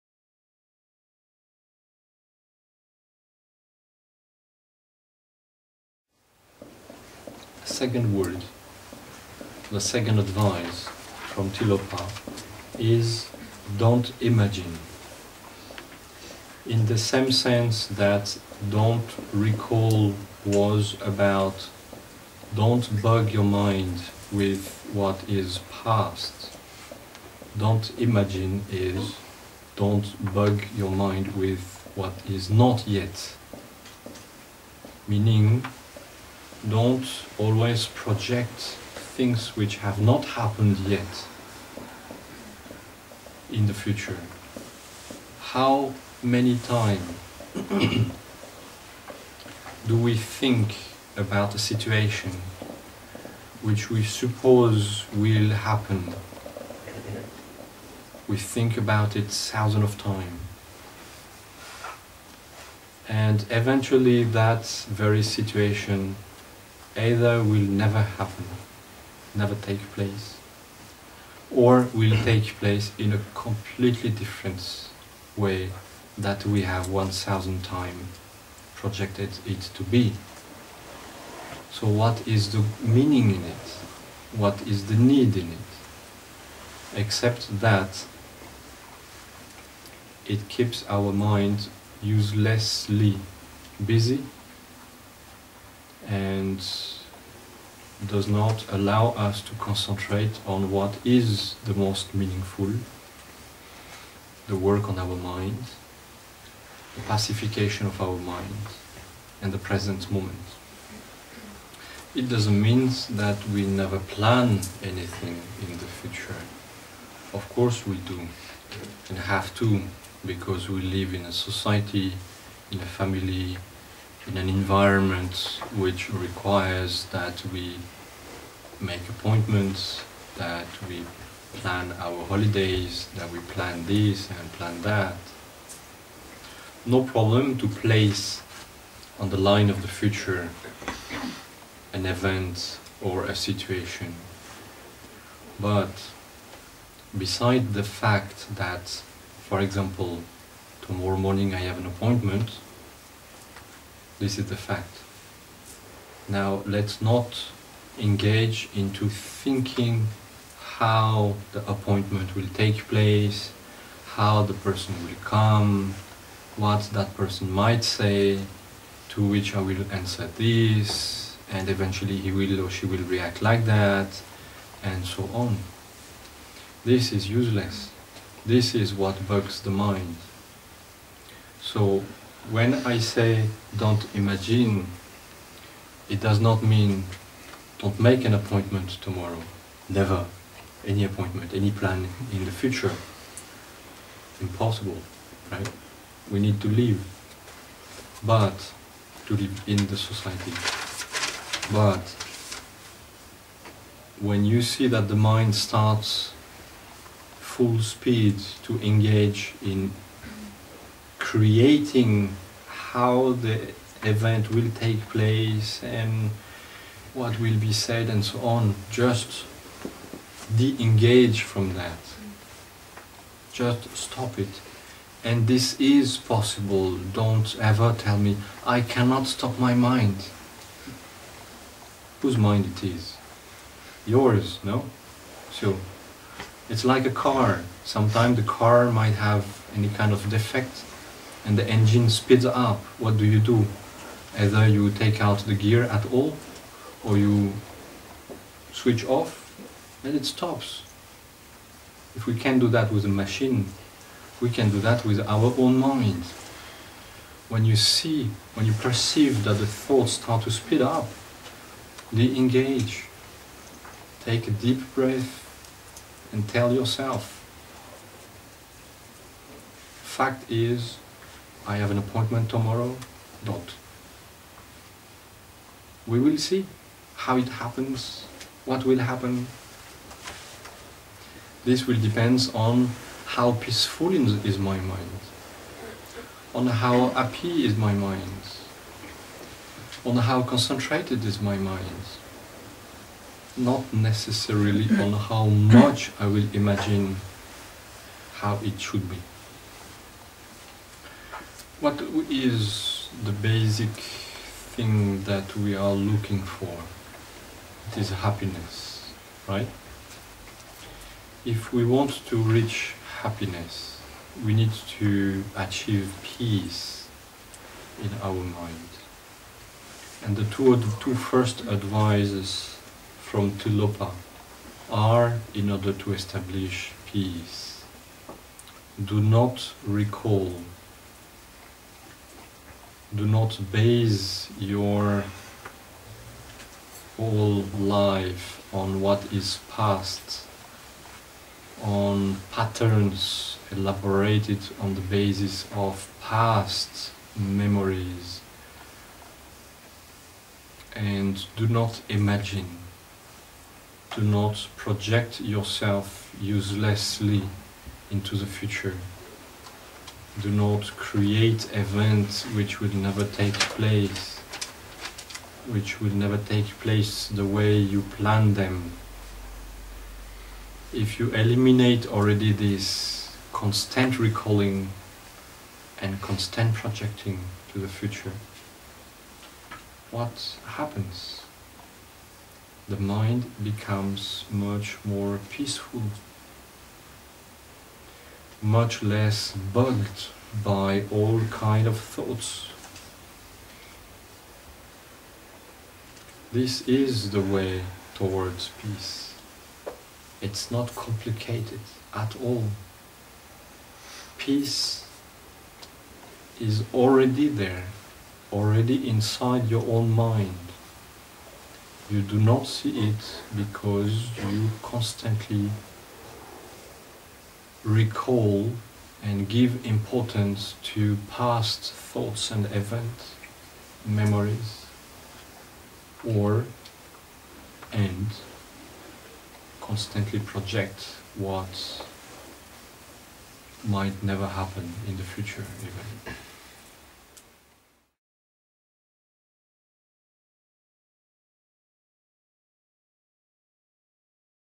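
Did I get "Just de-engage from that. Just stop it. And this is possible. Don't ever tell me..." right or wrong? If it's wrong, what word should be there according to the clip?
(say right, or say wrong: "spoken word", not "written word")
right.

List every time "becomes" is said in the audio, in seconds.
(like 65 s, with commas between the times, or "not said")
383 s.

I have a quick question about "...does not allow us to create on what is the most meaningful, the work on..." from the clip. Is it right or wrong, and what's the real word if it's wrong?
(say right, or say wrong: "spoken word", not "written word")
wrong: "concentrate", not "create".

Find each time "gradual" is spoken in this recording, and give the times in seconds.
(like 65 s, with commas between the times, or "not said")
not said.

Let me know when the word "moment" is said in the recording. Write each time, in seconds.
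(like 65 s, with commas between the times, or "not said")
110 s.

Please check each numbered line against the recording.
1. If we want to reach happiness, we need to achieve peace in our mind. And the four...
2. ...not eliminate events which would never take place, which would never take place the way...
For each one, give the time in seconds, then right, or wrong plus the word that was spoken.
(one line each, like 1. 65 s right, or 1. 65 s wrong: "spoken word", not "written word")
1. 311 s wrong: "two", not "four"
2. 360 s wrong: "create", not "eliminate".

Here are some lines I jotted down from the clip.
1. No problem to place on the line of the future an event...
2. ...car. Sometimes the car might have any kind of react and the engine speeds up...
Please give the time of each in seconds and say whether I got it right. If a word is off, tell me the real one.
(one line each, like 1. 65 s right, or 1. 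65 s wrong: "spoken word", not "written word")
1. 136 s right
2. 237 s wrong: "defect", not "react".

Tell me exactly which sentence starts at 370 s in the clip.
If you eliminate already this constant recalling and constant projecting to the future, what happens?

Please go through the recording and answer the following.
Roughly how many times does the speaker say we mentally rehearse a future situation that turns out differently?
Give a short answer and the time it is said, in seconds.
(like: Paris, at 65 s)
1000, at 76 s.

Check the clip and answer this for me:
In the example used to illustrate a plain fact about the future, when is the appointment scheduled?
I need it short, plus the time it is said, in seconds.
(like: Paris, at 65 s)
Tomorrow morning, at 150 s.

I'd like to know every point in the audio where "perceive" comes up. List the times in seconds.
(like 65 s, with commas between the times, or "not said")
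258 s.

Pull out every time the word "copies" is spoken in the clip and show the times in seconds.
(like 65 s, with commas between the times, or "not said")
not said.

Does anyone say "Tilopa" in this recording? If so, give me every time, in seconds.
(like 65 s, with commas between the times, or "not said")
11 s, 323 s.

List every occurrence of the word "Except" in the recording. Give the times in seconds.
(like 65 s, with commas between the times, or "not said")
86 s.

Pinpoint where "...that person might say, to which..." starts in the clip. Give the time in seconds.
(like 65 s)
166 s.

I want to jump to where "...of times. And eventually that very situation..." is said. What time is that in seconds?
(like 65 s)
59 s.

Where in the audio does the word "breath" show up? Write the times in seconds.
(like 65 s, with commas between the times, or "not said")
264 s.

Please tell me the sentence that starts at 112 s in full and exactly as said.
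It doesn't mean that we never plan anything in the future.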